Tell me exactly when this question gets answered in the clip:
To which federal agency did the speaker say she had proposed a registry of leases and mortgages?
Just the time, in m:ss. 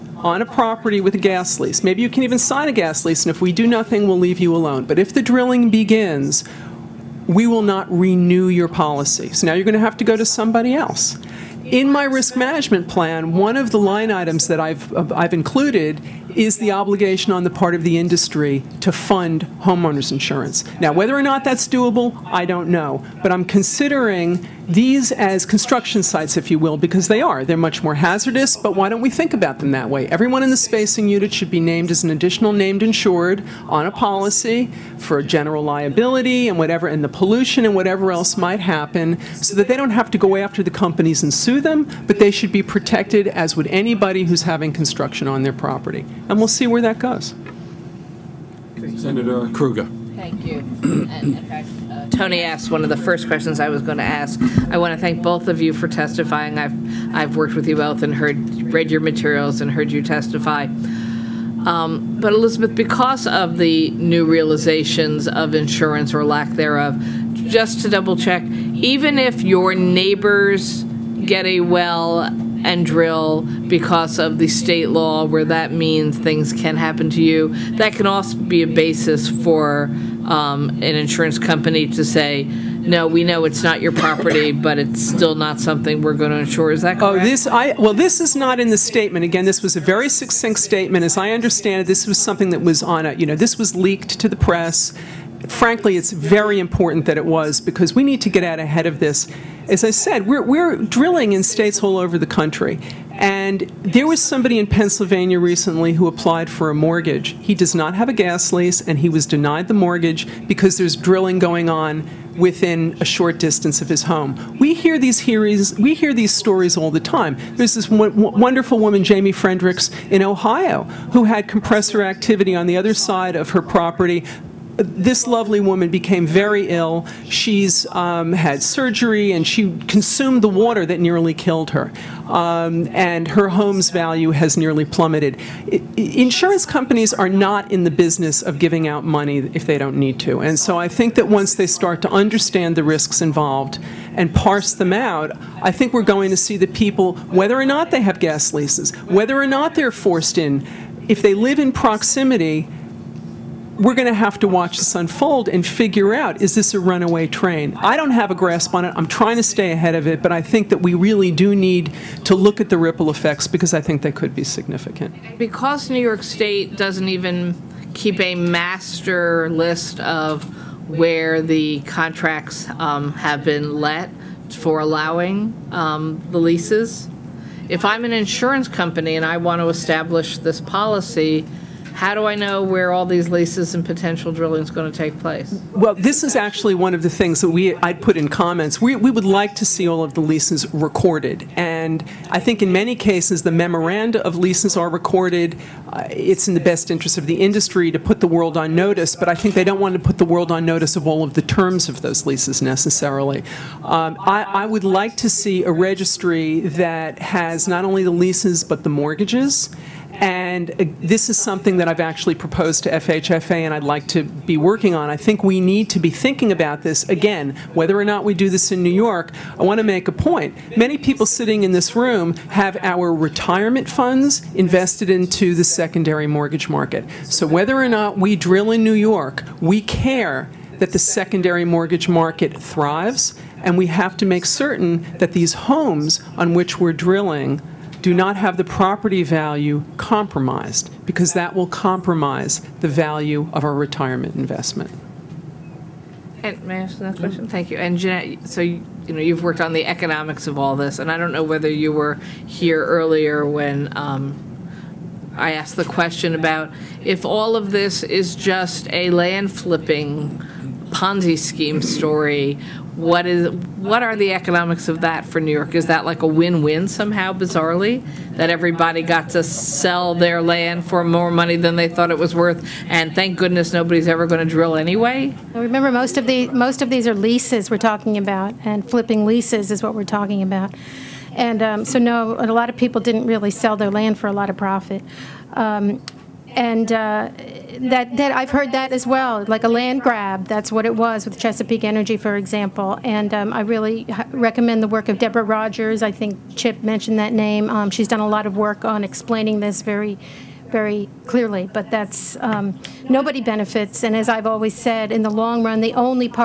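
3:32.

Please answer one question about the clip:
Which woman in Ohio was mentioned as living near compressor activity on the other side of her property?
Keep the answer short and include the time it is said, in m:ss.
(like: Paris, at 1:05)
Jamie Fredericks, at 1:59.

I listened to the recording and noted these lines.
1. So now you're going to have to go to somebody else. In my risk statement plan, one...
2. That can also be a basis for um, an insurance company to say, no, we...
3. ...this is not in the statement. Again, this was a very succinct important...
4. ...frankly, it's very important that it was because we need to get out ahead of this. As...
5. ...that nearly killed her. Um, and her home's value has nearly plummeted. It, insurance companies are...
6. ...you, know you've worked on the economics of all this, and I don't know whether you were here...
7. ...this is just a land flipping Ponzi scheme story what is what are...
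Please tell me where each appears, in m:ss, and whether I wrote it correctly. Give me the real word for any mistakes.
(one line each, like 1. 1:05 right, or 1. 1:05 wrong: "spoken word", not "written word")
1. 0:09 wrong: "management", not "statement"
2. 1:17 right
3. 1:27 wrong: "statement", not "important"
4. 1:35 right
5. 2:10 right
6. 4:09 right
7. 4:17 right.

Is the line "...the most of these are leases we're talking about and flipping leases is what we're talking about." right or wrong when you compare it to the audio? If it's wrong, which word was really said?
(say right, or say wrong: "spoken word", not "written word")
right.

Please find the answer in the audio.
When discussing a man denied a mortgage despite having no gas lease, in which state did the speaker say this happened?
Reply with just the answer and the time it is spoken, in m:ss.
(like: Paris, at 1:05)
Pennsylvania, at 1:44.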